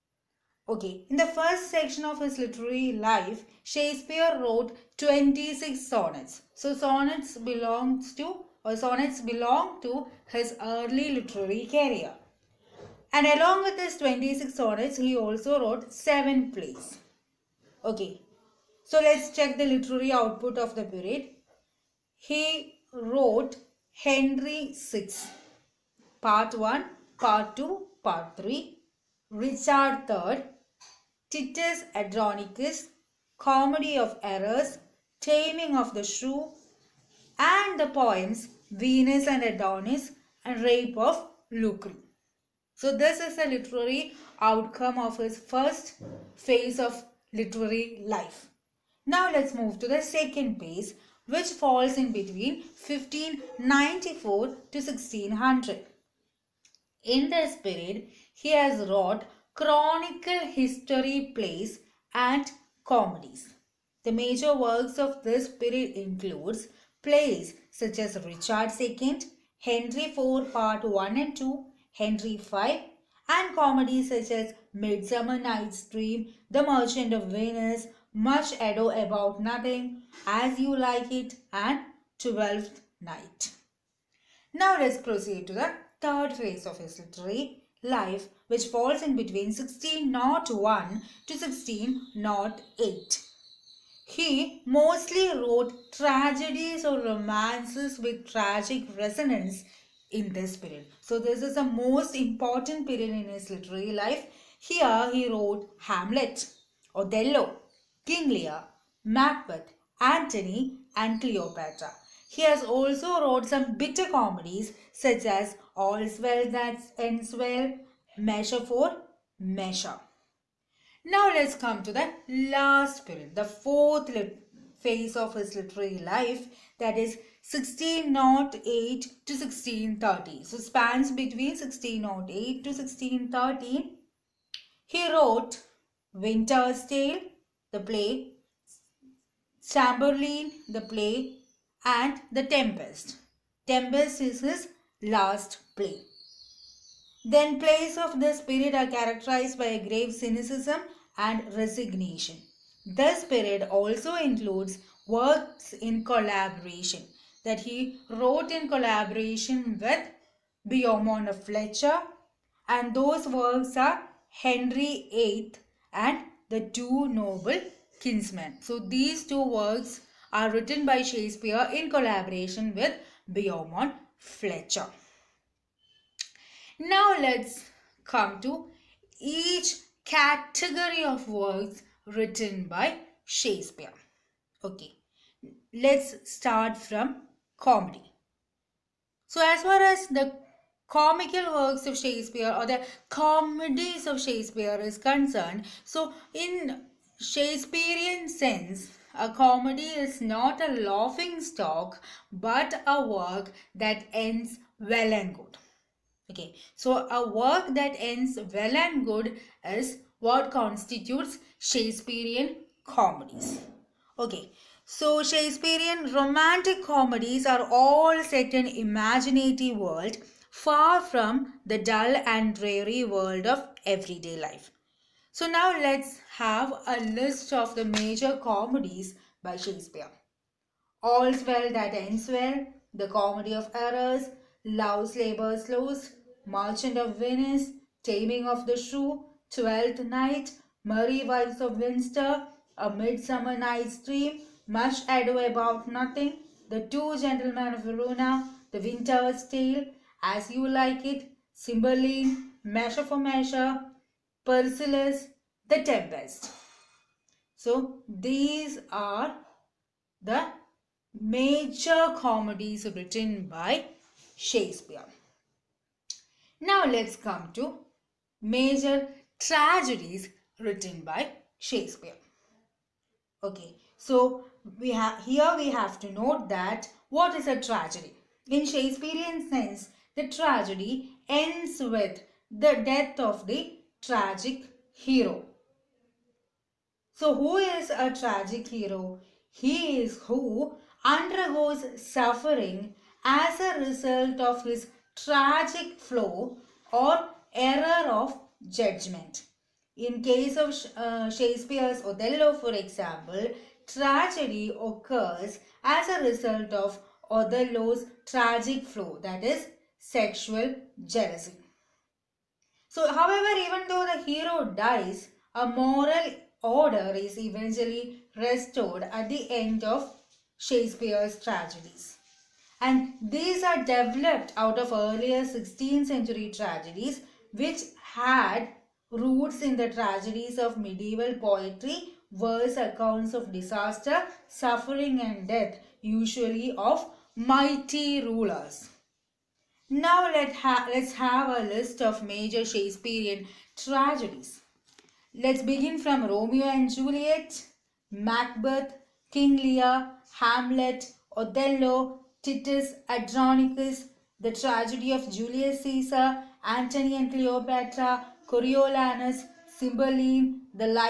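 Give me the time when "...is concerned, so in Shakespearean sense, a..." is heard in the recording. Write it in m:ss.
3:14.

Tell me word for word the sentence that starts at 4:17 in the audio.
So these are the major comedies written by Shakespeare.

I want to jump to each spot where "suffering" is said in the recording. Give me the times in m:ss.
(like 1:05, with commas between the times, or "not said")
4:52, 5:34.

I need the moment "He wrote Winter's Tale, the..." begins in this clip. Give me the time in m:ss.
2:14.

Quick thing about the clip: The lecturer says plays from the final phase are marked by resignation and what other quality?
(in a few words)
grave cynicism.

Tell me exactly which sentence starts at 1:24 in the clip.
Now let's proceed to the third phase of his literary life, which falls in between 1601 to 1608.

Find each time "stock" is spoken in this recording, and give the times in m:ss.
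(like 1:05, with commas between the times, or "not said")
3:21.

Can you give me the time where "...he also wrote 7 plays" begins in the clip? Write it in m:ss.
0:14.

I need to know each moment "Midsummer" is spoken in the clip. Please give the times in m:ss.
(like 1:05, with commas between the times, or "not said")
1:14, 4:02.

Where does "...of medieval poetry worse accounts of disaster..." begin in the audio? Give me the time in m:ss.
5:30.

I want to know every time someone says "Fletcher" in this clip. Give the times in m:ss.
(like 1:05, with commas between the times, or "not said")
2:41, 2:54.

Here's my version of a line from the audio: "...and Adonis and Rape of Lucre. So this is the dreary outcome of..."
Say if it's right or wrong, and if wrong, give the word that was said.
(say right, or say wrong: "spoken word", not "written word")
wrong: "literary", not "dreary".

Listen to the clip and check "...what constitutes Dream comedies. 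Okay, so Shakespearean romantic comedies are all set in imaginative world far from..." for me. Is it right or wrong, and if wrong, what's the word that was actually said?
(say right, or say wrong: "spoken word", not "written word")
wrong: "Shakespearean", not "Dream".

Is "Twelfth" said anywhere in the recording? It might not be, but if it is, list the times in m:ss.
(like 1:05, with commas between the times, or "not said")
1:22, 3:59.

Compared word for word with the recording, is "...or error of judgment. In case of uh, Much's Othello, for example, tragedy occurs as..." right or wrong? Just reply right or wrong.
wrong.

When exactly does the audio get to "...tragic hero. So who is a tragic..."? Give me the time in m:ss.
4:44.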